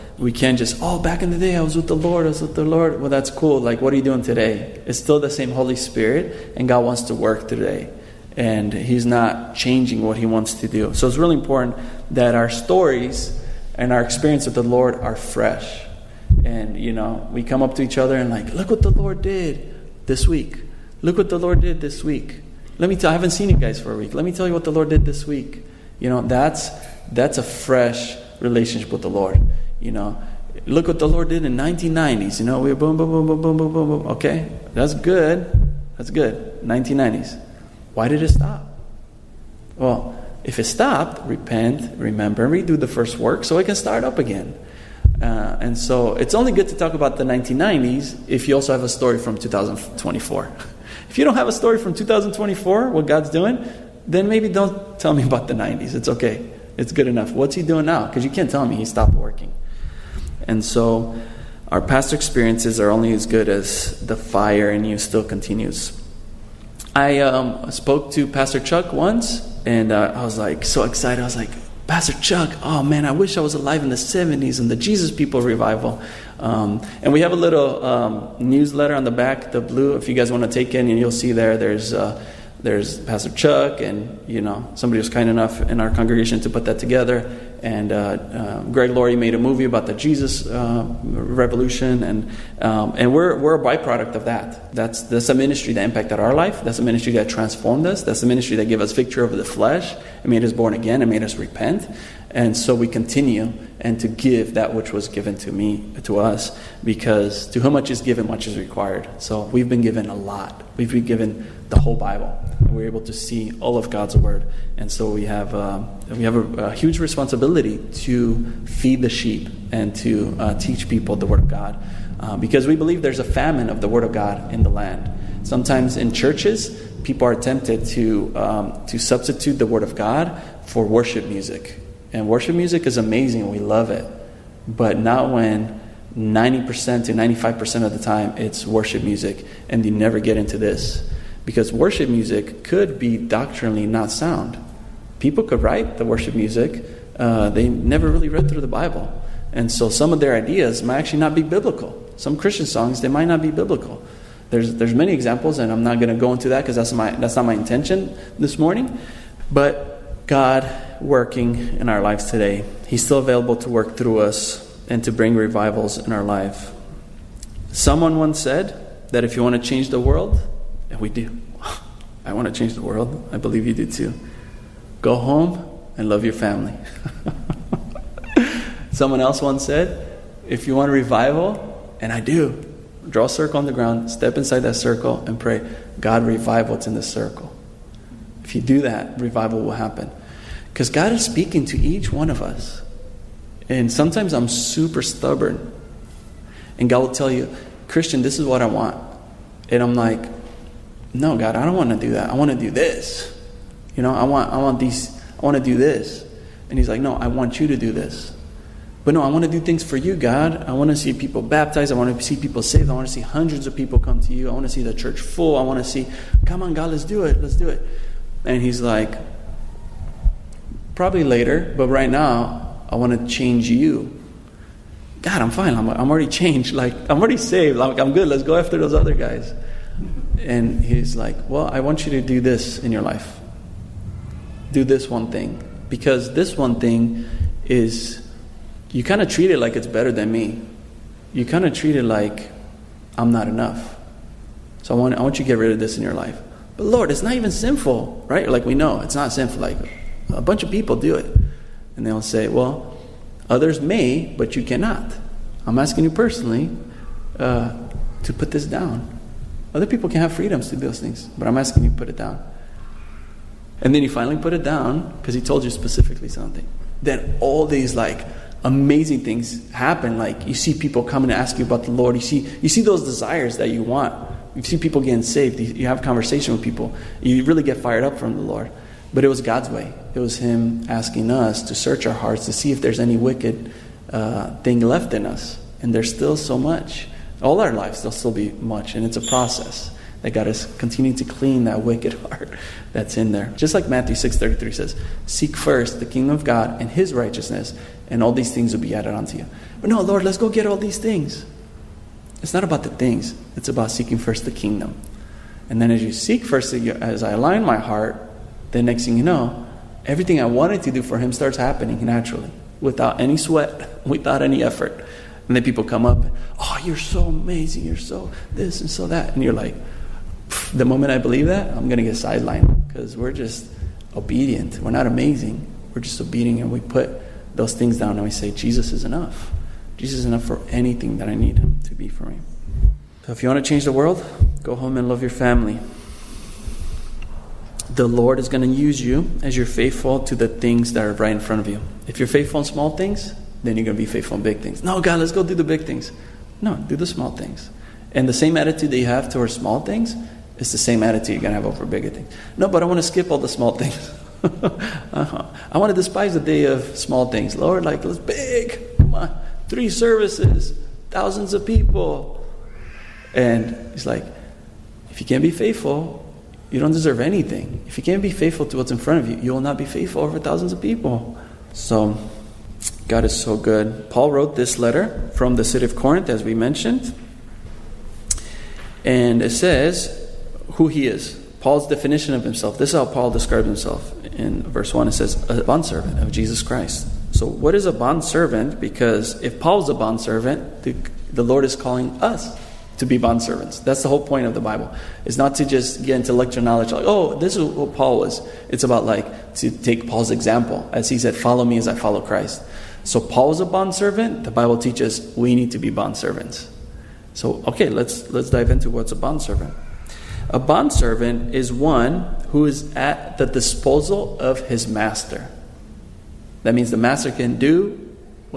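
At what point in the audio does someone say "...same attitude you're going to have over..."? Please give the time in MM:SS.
05:50.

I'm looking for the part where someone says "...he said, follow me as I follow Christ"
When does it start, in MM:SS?
06:41.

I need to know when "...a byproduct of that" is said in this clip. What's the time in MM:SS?
01:33.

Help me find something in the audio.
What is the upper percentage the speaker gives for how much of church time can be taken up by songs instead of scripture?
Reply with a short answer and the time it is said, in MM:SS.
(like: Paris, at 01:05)
95%, at 02:17.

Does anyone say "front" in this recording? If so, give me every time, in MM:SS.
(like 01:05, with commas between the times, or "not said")
05:41, 06:08.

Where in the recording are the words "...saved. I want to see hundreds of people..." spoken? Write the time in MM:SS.
03:32.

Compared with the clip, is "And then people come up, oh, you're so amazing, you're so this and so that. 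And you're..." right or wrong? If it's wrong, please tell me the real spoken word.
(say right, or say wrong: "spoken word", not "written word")
right.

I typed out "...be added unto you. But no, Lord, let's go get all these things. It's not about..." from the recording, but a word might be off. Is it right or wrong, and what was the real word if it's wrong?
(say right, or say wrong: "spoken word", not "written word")
right.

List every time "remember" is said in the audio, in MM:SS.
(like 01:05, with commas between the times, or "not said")
00:41.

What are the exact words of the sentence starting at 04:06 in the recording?
But Lord, it's not even sinful, right?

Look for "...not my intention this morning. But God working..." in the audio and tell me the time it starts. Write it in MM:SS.
02:37.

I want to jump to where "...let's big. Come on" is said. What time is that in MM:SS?
05:58.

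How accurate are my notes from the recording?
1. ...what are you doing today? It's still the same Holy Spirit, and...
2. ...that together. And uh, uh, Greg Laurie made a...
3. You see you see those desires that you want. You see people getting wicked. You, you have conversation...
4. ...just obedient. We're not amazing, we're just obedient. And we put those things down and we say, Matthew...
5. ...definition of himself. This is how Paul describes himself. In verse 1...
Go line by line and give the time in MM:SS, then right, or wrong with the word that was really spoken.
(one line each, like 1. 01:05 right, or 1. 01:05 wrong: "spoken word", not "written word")
1. 00:03 right
2. 01:26 right
3. 04:32 wrong: "saved", not "wicked"
4. 05:23 wrong: "Jesus", not "Matthew"
5. 06:21 right.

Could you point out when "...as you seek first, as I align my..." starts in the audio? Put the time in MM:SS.
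05:05.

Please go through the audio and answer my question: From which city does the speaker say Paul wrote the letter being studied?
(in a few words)
Corinth.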